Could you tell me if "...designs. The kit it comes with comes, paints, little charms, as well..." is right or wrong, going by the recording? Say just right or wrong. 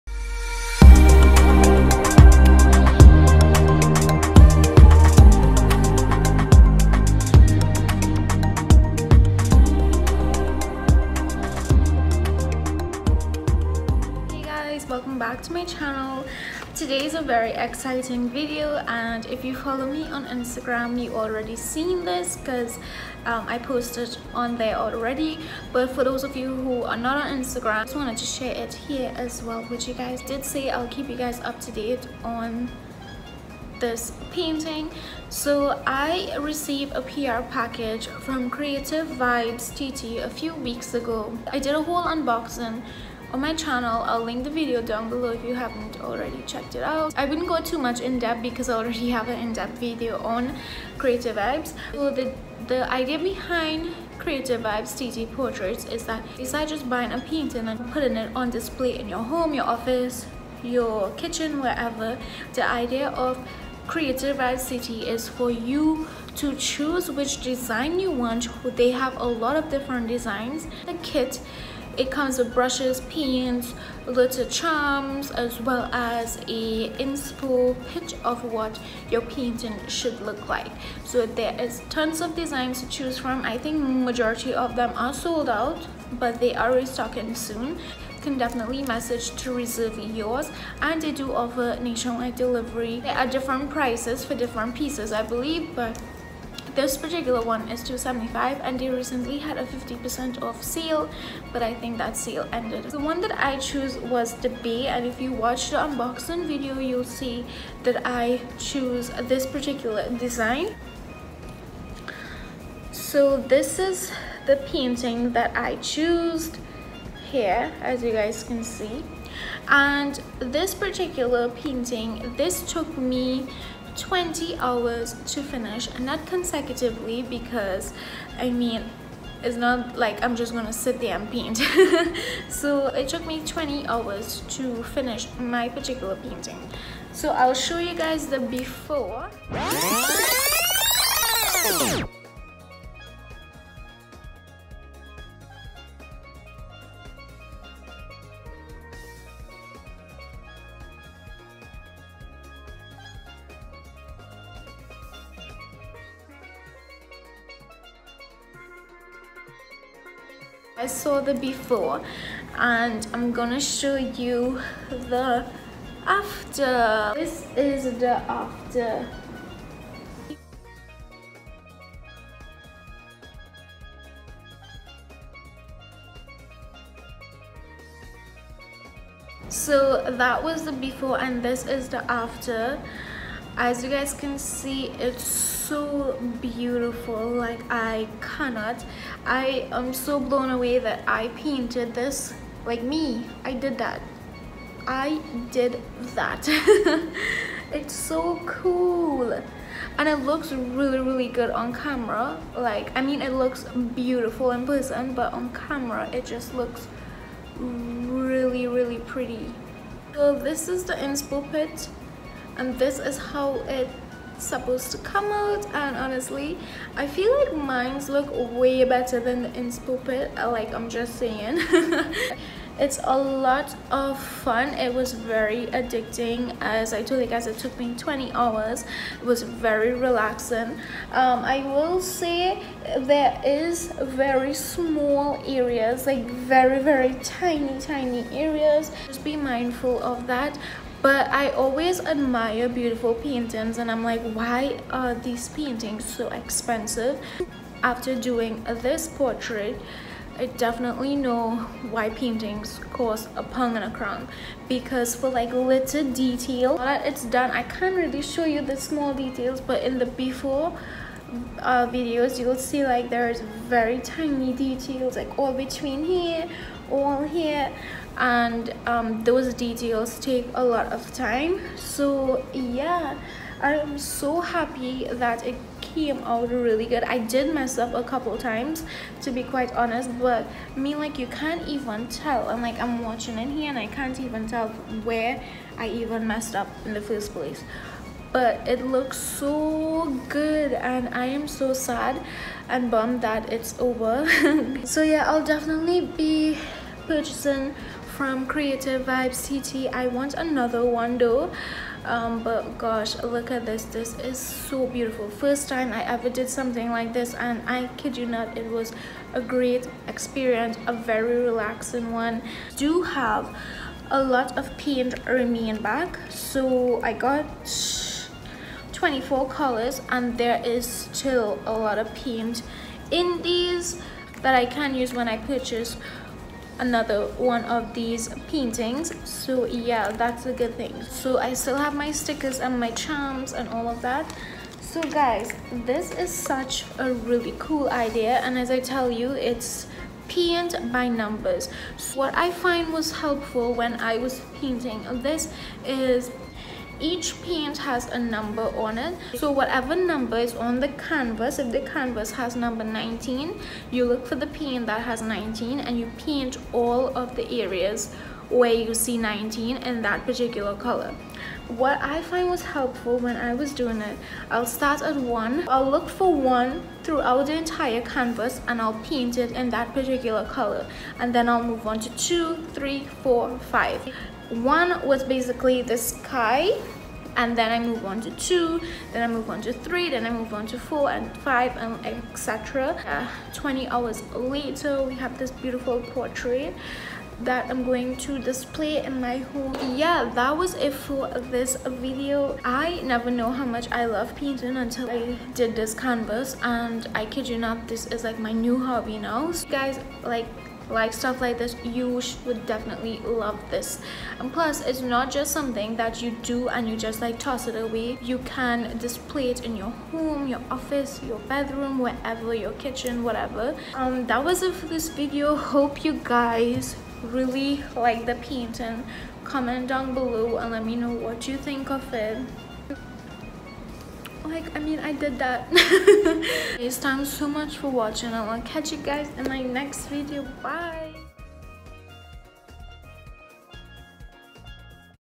wrong.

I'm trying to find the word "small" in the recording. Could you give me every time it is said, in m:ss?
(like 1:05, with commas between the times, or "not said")
3:54, 4:18.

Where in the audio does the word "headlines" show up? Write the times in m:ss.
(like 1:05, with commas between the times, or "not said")
not said.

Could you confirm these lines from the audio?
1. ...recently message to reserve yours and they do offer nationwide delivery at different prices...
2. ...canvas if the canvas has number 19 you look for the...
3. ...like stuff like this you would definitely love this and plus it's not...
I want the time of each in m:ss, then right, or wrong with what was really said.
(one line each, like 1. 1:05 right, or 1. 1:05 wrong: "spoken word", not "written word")
1. 1:28 wrong: "definitely", not "recently"
2. 5:50 right
3. 6:40 right.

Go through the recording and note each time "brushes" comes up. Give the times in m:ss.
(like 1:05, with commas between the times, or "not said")
1:12.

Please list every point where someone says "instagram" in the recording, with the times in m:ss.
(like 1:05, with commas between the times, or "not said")
0:20, 0:27.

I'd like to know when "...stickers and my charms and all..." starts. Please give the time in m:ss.
5:32.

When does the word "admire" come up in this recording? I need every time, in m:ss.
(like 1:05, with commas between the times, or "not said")
4:01.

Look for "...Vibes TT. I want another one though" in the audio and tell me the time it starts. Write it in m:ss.
4:59.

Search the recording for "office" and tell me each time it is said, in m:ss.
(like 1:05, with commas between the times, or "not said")
0:59, 6:50.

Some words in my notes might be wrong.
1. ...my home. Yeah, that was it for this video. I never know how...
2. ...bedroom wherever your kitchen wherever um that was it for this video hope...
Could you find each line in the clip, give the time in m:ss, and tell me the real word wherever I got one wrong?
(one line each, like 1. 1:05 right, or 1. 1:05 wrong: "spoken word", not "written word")
1. 6:29 right
2. 6:51 wrong: "whatever", not "wherever".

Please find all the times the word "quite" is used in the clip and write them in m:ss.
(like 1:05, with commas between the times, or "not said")
4:39.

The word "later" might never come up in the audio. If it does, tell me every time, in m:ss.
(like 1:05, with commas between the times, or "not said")
6:24.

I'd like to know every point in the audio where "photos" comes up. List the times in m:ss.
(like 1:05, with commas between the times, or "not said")
not said.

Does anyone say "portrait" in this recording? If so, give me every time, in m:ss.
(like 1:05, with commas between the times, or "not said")
0:55, 4:09, 6:26.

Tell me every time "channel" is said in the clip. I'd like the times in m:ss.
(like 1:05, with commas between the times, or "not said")
0:15, 0:43.